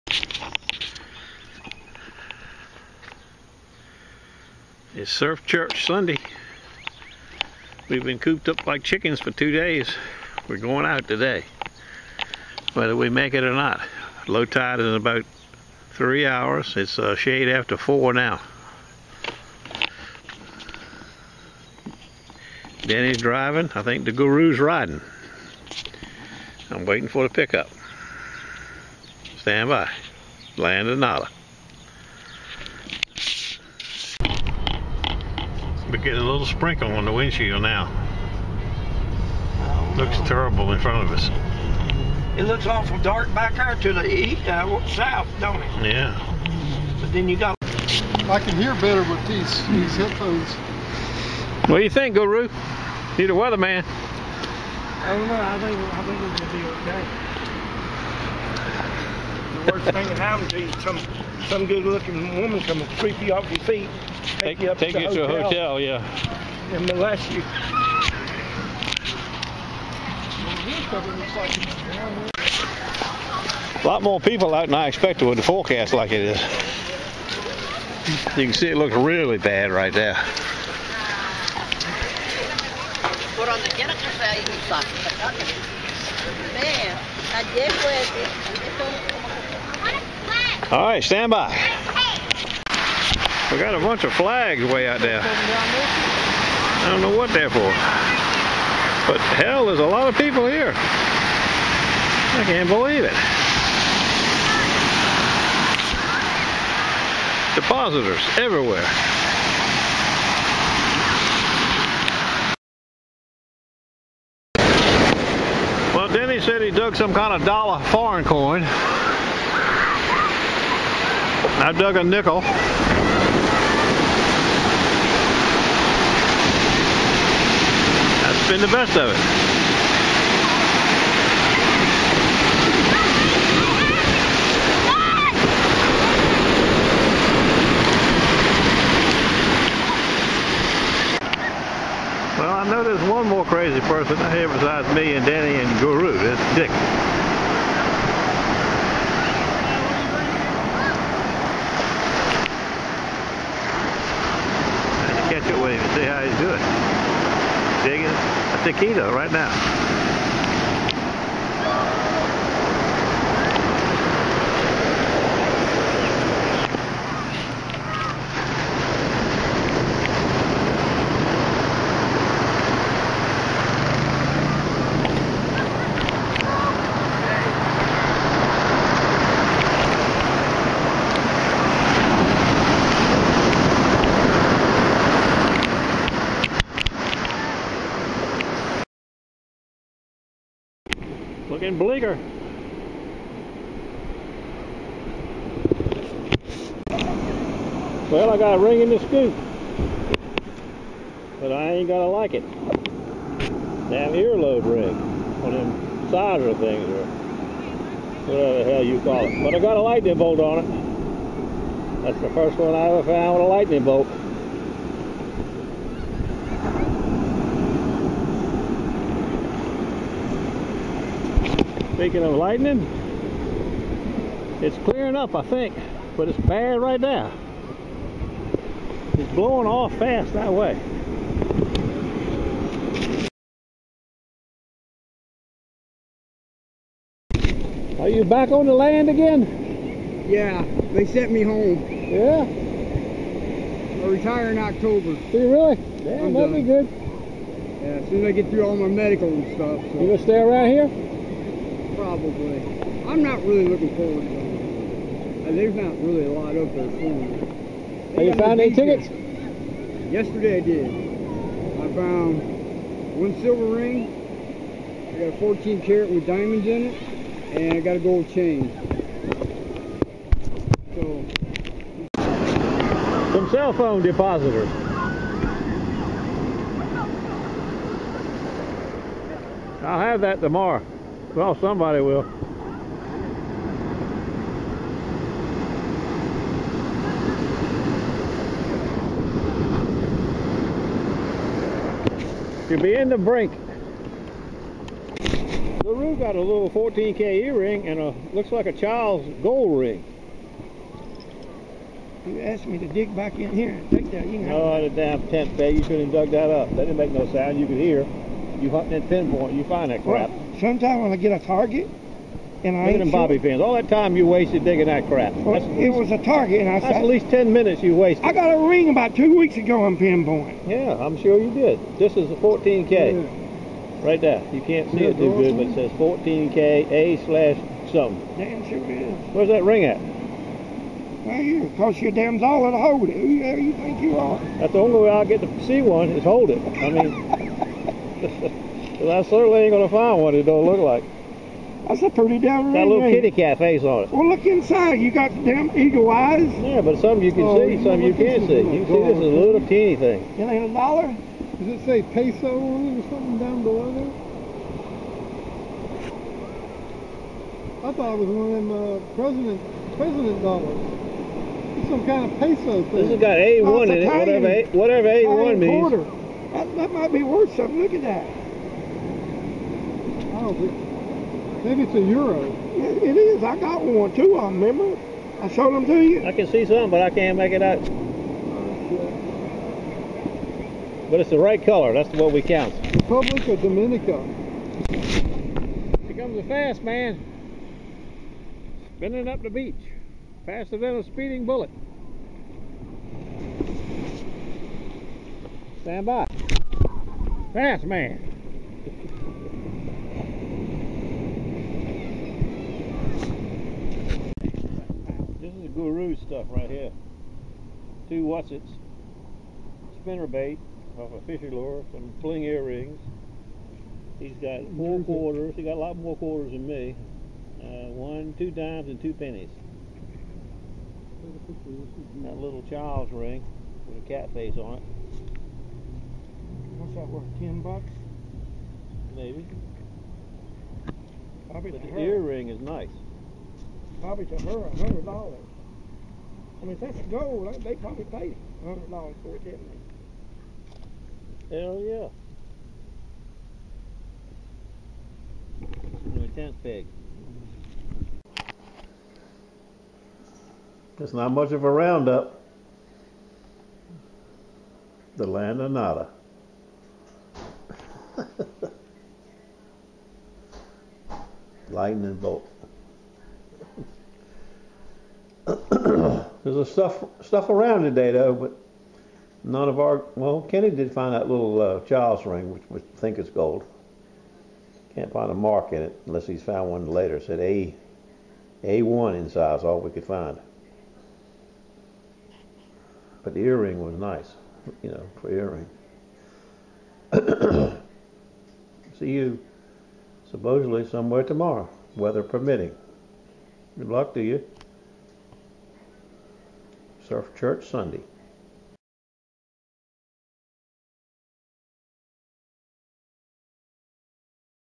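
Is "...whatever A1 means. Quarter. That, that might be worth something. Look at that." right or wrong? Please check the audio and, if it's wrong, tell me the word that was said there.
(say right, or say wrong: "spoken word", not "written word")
right.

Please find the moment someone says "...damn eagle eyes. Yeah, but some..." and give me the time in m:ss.
5:45.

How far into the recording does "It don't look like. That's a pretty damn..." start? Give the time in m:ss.
5:40.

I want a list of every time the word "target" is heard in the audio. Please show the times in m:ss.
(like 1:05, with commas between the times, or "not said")
5:11, 5:16.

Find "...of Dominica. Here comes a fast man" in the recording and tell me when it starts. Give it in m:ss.
6:23.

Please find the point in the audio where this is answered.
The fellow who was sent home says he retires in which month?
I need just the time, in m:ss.
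4:04.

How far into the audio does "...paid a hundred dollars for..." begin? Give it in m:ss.
7:18.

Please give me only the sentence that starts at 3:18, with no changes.
Well, I got a ring in the scoop.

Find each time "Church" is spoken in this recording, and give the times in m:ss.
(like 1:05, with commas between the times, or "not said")
0:05, 8:17.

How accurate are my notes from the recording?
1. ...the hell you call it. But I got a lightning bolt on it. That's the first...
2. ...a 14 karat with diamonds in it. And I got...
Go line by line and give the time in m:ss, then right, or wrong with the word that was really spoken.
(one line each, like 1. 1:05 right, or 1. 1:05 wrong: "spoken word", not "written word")
1. 3:28 right
2. 4:25 right.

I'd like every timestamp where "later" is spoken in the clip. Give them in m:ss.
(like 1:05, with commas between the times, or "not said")
7:56.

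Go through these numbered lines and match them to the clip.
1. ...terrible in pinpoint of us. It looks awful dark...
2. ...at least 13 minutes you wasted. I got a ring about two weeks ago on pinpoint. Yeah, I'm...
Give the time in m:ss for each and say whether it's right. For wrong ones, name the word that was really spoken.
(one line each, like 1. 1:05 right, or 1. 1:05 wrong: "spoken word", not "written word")
1. 0:40 wrong: "front", not "pinpoint"
2. 5:17 wrong: "10", not "13".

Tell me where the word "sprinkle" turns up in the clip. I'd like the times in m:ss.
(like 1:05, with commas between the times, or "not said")
0:36.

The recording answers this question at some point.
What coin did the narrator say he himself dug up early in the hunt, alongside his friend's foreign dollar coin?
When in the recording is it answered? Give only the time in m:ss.
2:01.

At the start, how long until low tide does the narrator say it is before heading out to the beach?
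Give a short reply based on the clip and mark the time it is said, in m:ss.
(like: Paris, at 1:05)
3 hours, at 0:14.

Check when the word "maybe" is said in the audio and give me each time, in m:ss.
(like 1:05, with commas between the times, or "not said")
6:11, 7:09.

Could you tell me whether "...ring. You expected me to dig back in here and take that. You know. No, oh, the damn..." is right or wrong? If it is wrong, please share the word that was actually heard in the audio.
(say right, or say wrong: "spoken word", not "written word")
wrong: "asked", not "expected".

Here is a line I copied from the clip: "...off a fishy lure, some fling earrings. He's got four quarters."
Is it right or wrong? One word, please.
right.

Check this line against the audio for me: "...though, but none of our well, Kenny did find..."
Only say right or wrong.
right.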